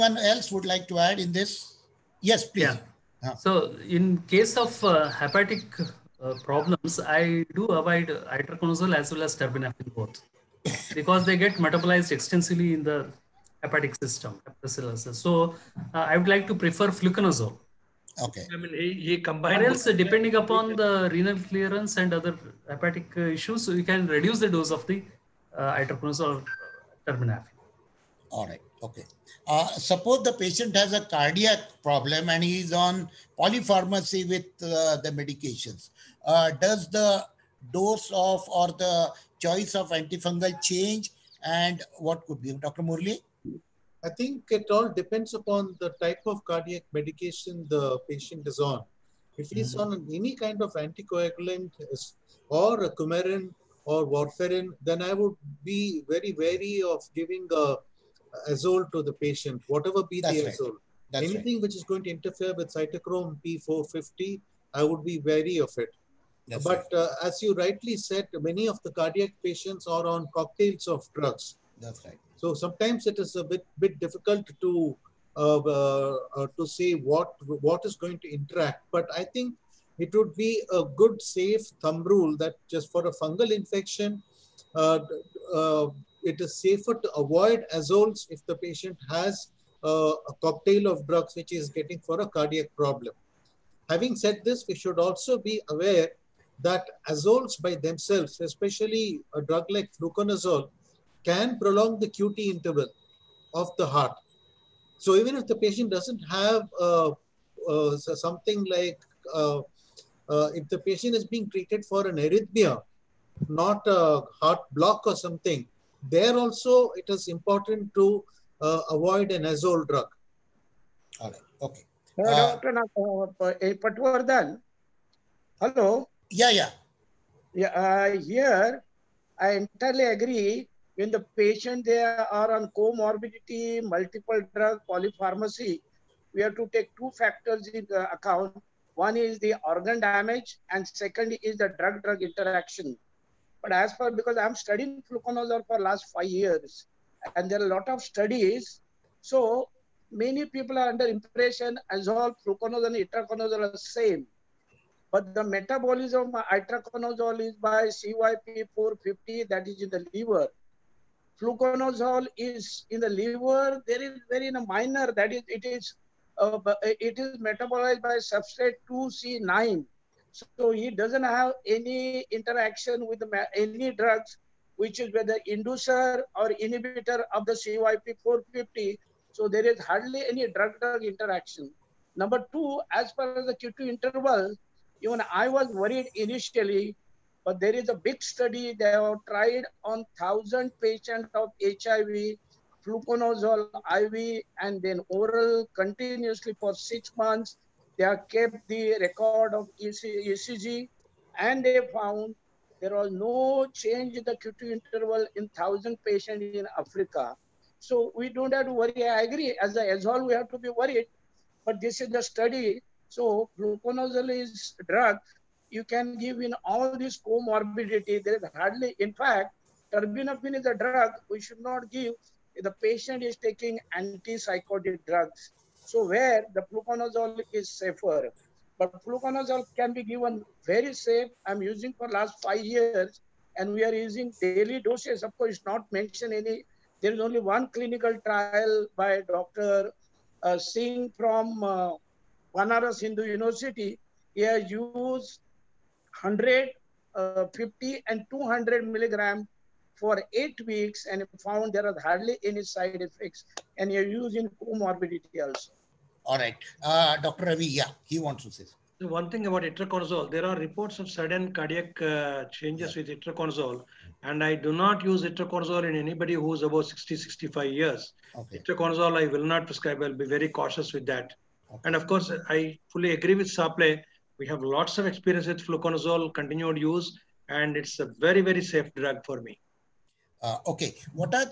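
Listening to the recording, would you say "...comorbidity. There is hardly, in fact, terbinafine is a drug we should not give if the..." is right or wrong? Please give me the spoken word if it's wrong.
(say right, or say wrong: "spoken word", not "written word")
right.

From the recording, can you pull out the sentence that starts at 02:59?
So there is hardly any drug-drug interaction.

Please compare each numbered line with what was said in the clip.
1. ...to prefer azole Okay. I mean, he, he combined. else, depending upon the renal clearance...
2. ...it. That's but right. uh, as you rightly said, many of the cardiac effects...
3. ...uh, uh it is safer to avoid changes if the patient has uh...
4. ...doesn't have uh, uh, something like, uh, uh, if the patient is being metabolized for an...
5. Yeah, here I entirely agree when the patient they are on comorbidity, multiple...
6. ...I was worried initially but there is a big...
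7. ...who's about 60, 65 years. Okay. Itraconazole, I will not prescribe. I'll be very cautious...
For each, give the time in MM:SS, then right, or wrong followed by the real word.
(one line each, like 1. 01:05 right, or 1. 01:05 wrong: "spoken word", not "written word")
1. 00:16 wrong: "fluconazole", not "azole"
2. 01:05 wrong: "patients", not "effects"
3. 01:24 wrong: "azoles", not "changes"
4. 01:45 wrong: "treated", not "metabolized"
5. 02:07 right
6. 03:05 right
7. 04:26 right.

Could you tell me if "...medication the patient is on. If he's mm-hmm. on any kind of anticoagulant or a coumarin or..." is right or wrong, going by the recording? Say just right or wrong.
right.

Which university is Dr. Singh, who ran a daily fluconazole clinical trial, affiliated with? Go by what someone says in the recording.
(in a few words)
Banaras Hindu University.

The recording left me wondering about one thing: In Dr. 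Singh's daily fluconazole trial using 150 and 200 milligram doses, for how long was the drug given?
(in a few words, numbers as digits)
8 weeks.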